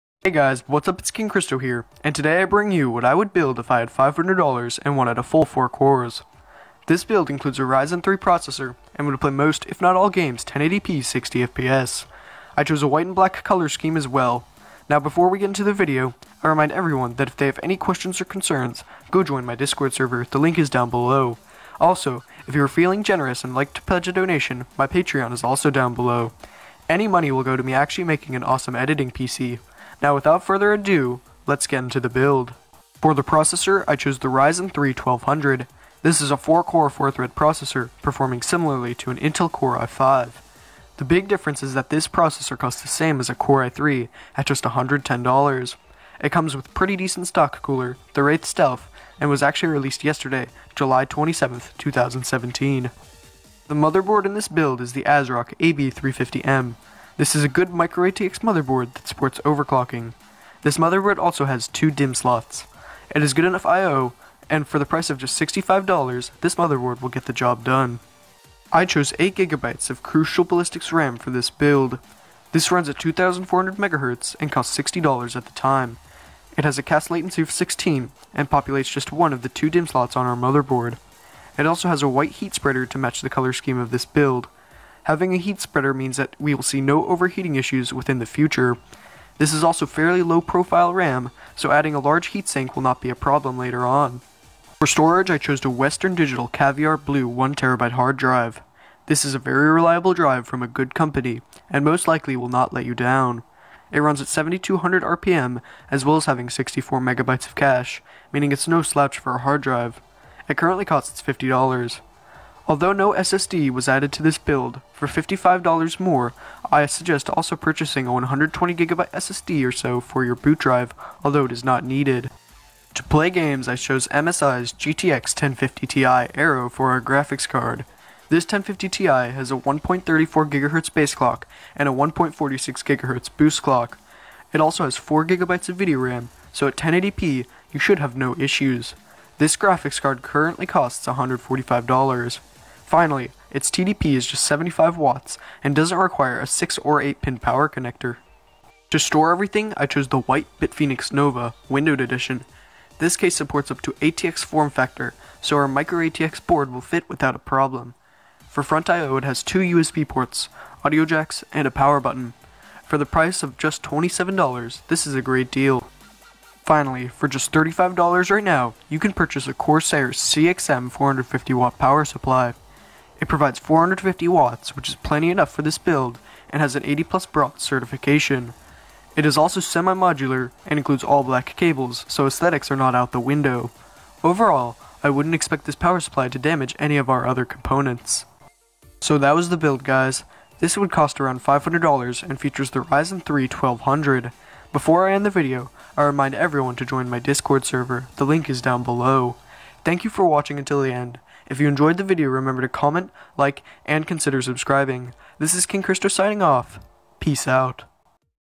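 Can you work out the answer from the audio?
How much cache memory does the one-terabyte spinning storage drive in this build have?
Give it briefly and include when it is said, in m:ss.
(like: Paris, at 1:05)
64 megabytes, at 1:46.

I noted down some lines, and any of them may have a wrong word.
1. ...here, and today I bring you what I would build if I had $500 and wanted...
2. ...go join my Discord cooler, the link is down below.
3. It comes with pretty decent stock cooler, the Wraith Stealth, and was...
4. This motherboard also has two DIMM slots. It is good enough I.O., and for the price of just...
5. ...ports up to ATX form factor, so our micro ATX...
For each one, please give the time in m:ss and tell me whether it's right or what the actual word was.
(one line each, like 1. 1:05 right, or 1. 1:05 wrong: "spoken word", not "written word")
1. 0:01 right
2. 0:19 wrong: "server", not "cooler"
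3. 0:46 right
4. 1:00 right
5. 2:33 wrong: "supports", not "ports".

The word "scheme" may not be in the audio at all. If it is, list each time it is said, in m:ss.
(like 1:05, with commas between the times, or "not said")
0:13, 1:23.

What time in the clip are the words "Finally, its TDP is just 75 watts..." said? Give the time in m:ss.
2:22.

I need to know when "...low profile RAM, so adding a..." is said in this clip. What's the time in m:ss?
1:30.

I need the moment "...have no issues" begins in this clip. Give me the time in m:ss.
2:17.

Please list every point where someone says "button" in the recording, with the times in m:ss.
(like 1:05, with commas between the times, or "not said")
2:42.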